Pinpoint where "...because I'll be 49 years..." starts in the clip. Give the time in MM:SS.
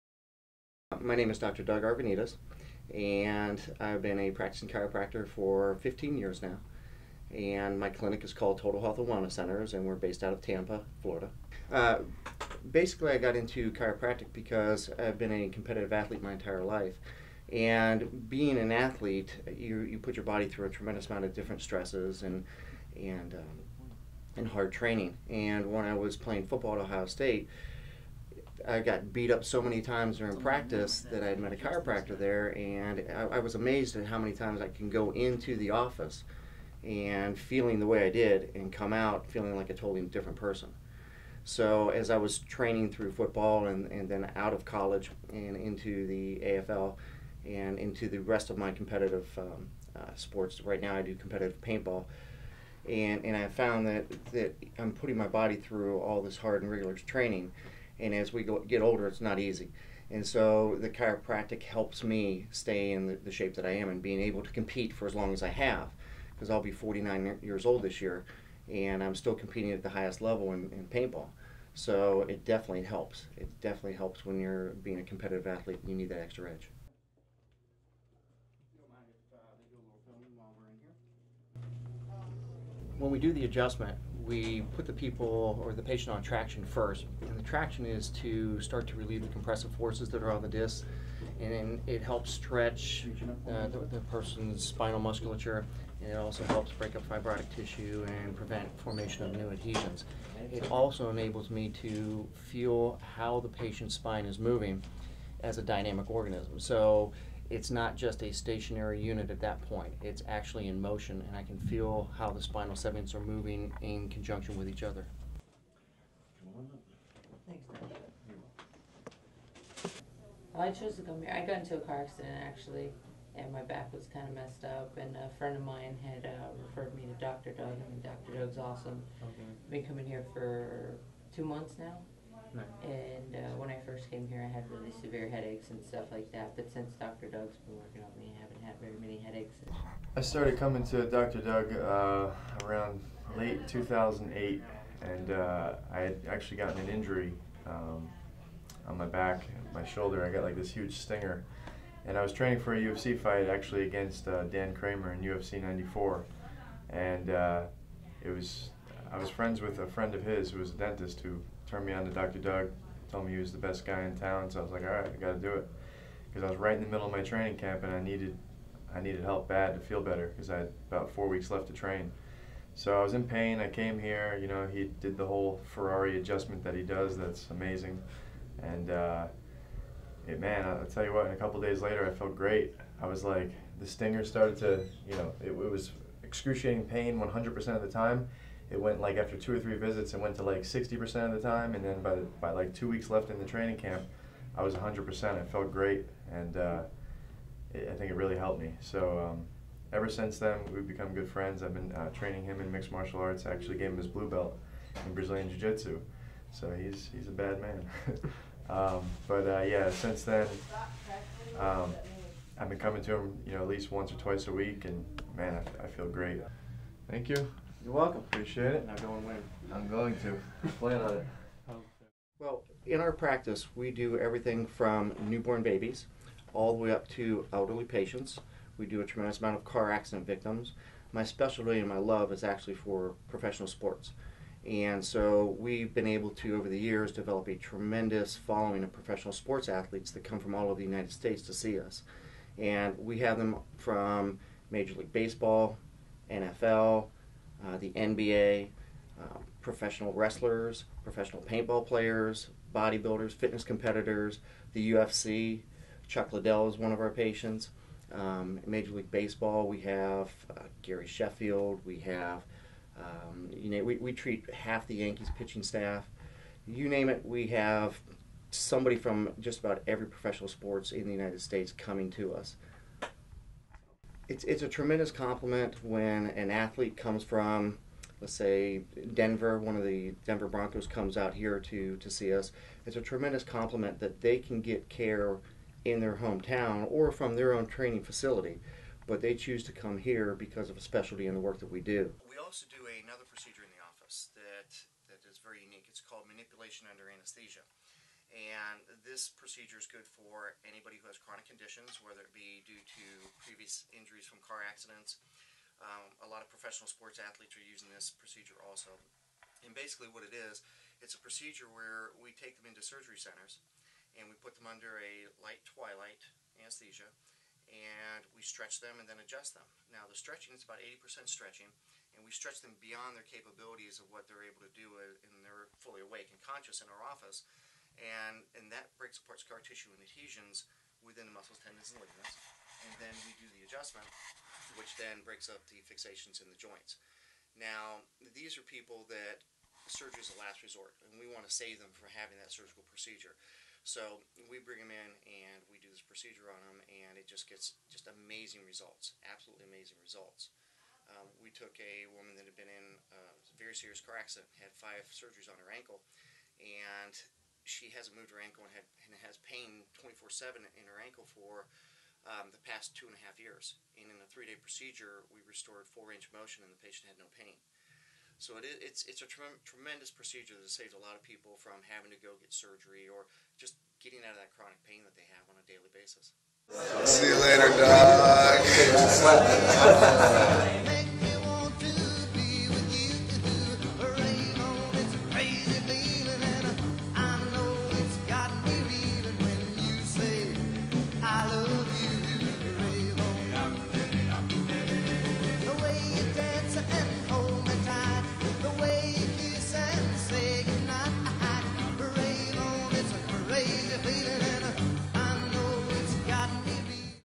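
01:06.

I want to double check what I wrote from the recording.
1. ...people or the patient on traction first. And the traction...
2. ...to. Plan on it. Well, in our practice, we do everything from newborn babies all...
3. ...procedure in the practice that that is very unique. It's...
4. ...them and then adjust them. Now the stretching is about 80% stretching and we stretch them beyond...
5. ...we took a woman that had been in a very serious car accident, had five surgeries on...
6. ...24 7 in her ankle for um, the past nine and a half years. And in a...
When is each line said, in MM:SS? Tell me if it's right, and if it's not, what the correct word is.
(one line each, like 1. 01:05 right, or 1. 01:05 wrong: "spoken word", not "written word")
1. 01:24 right
2. 03:40 right
3. 04:53 wrong: "office", not "practice"
4. 05:18 right
5. 05:51 right
6. 05:59 wrong: "two", not "nine".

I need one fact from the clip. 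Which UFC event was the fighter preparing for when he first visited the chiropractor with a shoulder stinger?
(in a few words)
UFC 94.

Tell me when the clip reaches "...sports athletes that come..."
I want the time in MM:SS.
03:59.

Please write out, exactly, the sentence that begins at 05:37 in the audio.
Now, these are people that surgery is a last resort, and we want to save them from having that surgical procedure.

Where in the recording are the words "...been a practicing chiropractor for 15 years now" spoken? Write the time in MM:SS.
00:04.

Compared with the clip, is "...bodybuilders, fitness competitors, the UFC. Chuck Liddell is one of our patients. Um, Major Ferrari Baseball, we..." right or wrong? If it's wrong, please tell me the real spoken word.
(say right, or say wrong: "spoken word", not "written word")
wrong: "League", not "Ferrari".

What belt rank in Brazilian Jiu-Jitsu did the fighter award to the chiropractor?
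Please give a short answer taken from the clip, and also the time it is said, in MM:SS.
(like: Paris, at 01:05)
blue belt, at 03:24.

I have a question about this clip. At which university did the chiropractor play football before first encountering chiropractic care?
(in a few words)
Ohio State.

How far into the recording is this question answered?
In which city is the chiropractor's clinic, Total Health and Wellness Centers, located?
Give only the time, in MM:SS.
00:10.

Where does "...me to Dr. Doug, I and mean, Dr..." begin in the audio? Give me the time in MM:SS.
02:06.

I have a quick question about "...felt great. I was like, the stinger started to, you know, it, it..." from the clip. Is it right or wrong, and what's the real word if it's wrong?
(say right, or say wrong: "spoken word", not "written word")
right.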